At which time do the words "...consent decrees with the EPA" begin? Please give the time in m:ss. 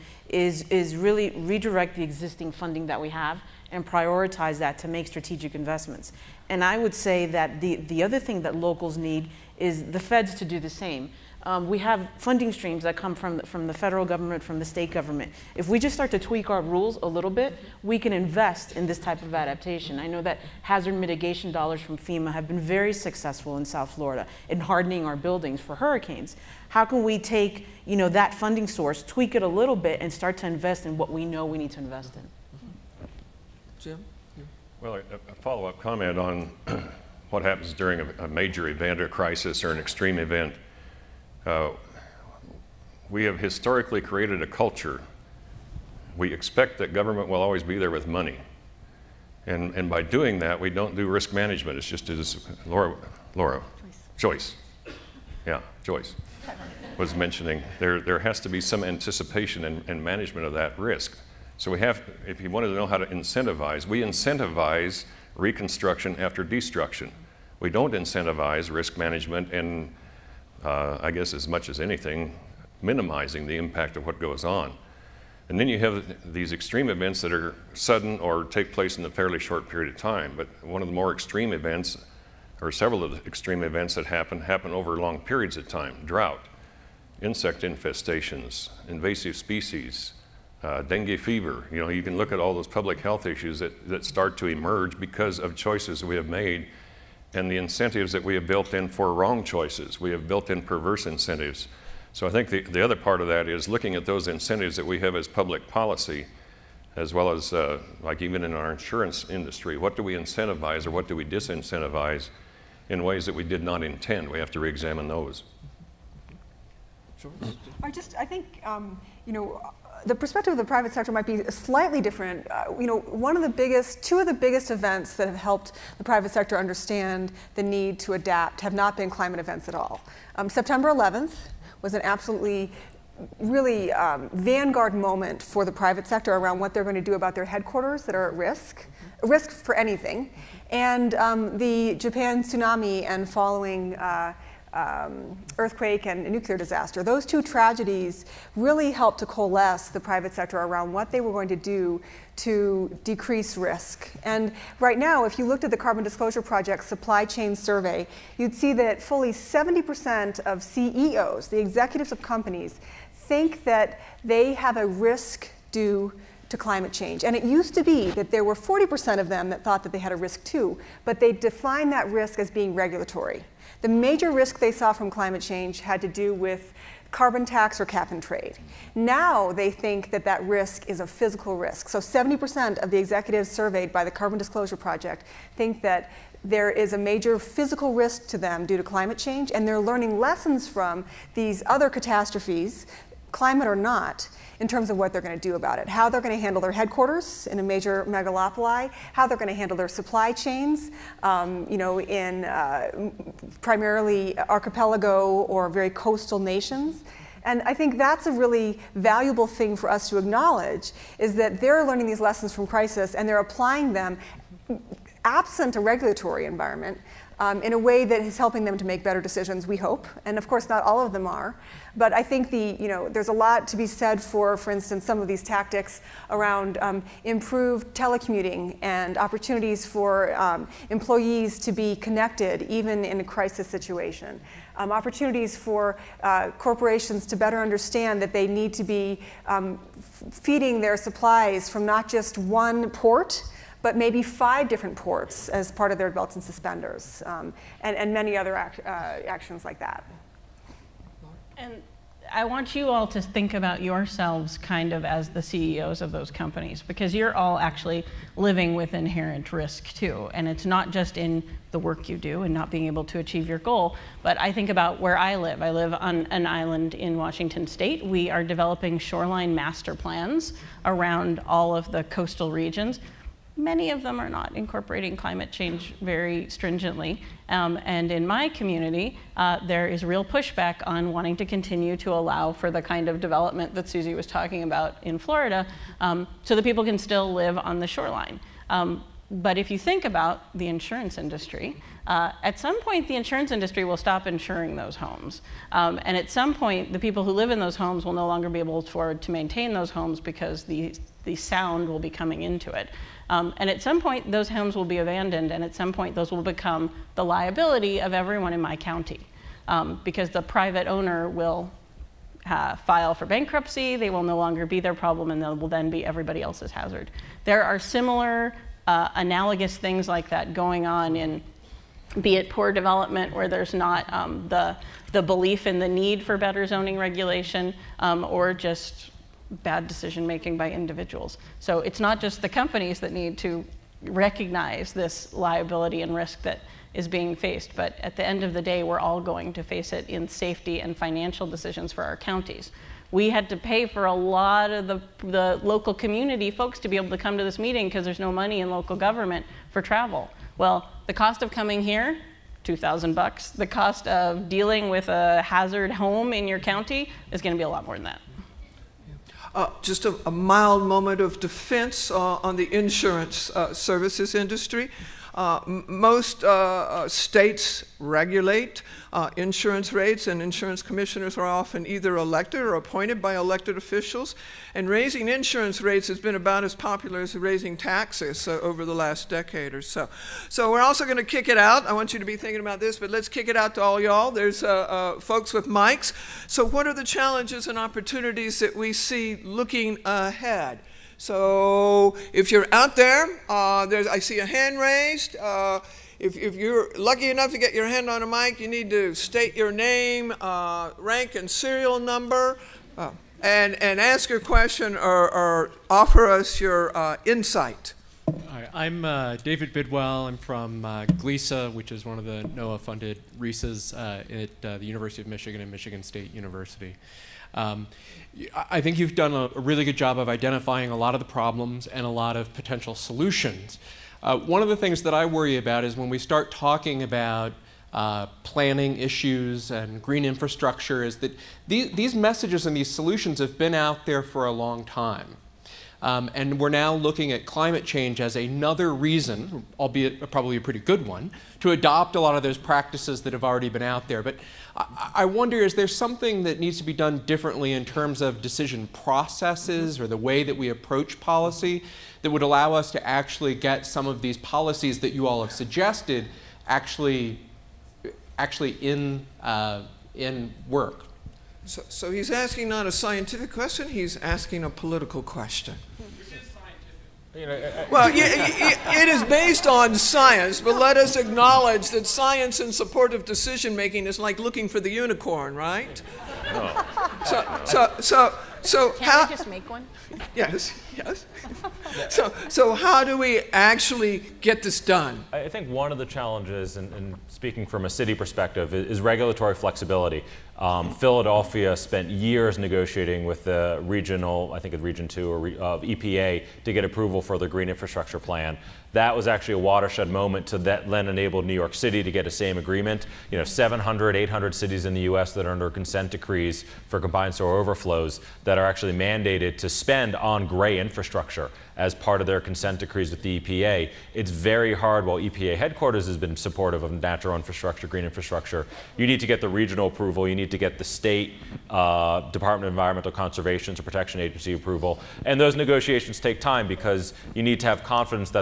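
8:32.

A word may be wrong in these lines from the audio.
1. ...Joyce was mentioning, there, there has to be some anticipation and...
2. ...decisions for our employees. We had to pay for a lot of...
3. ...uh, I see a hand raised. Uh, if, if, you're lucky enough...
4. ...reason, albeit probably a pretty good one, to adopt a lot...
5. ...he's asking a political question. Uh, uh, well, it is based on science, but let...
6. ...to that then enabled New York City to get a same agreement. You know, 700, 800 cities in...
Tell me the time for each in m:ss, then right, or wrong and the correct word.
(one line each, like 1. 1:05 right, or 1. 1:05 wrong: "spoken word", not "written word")
1. 0:55 right
2. 5:41 wrong: "counties", not "employees"
3. 6:33 right
4. 7:18 right
5. 7:43 right
6. 8:20 right.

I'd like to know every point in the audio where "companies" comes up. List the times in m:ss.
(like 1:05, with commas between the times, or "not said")
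2:42, 4:16, 5:32.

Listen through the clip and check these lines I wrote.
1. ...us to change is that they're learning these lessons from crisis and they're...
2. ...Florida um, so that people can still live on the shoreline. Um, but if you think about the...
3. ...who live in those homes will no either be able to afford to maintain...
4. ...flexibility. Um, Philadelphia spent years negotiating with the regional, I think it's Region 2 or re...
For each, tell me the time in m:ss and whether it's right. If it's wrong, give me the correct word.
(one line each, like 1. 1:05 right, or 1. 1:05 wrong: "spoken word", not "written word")
1. 3:29 wrong: "acknowledge", not "change"
2. 4:45 right
3. 4:57 wrong: "longer", not "either"
4. 8:09 right.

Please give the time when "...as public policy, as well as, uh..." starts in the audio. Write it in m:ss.
1:45.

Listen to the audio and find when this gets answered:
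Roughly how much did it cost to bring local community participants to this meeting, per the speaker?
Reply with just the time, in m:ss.
5:52.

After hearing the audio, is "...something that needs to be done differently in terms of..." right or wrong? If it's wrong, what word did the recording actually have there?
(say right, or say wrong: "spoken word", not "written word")
right.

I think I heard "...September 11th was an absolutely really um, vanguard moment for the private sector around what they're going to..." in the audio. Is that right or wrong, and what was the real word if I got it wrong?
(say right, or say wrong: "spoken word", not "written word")
right.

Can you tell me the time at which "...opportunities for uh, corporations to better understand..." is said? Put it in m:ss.
3:54.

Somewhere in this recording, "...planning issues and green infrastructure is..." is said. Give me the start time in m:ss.
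7:08.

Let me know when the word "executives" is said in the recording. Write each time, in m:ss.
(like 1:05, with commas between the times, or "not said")
2:41, 3:02.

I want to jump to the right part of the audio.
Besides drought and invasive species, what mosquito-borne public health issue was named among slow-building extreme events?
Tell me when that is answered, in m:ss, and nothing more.
1:30.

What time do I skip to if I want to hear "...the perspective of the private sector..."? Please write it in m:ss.
2:00.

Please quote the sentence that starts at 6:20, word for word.
So we're also going to kick it out.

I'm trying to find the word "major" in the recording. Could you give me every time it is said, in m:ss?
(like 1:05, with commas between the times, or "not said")
0:38, 2:53, 3:06, 3:17.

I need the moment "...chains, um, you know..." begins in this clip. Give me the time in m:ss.
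3:20.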